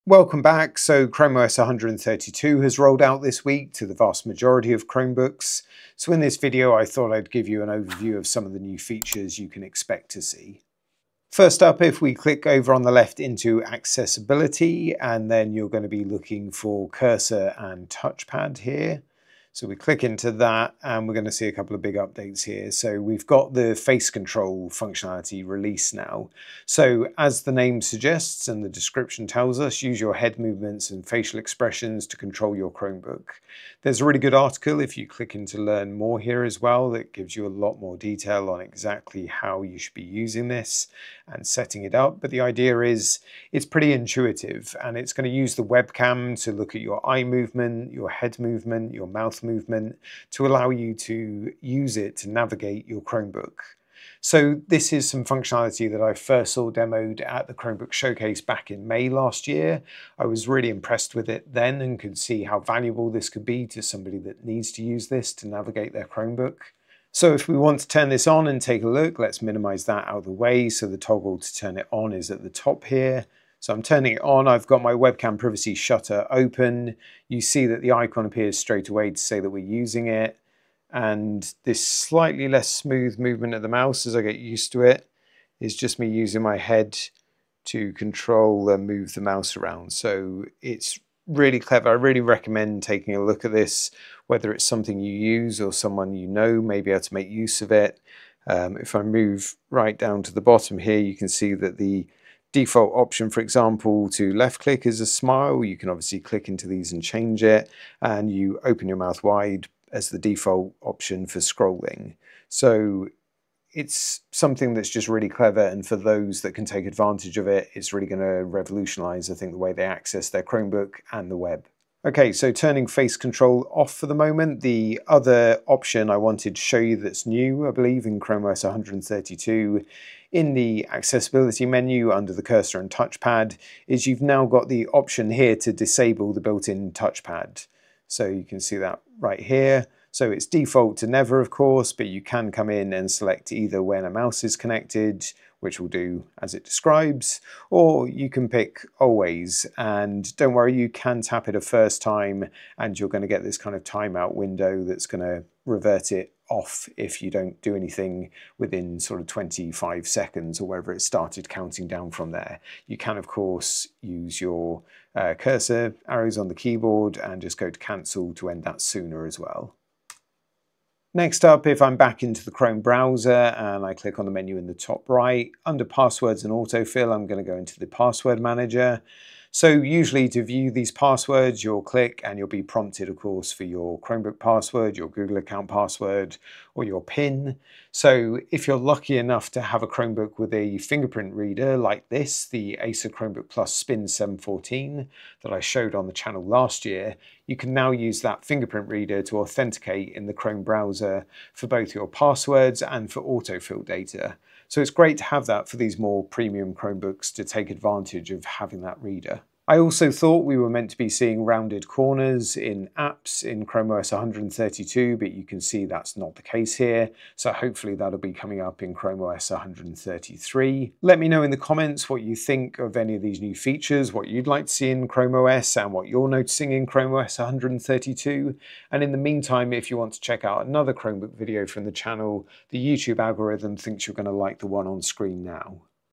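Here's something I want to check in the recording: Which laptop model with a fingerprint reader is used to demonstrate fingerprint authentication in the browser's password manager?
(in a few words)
Acer Chromebook Plus Spin 714.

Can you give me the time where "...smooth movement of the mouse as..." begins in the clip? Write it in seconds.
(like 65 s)
82 s.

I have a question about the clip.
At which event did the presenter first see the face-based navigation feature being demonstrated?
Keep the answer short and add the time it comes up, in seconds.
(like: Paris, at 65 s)
Chromebook Showcase, at 57 s.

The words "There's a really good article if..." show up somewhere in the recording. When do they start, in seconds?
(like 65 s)
33 s.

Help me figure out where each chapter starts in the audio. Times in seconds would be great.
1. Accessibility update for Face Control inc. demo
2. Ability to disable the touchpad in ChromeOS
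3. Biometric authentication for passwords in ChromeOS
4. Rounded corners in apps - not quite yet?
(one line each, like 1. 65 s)
1. 11 s
2. 125 s
3. 171 s
4. 210 s.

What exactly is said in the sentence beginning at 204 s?
So it's great to have that for these more premium Chromebooks to take advantage of having that reader.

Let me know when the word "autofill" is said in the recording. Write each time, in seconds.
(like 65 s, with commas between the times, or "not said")
176 s, 203 s.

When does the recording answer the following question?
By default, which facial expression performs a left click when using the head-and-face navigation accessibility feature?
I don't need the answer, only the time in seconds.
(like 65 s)
104 s.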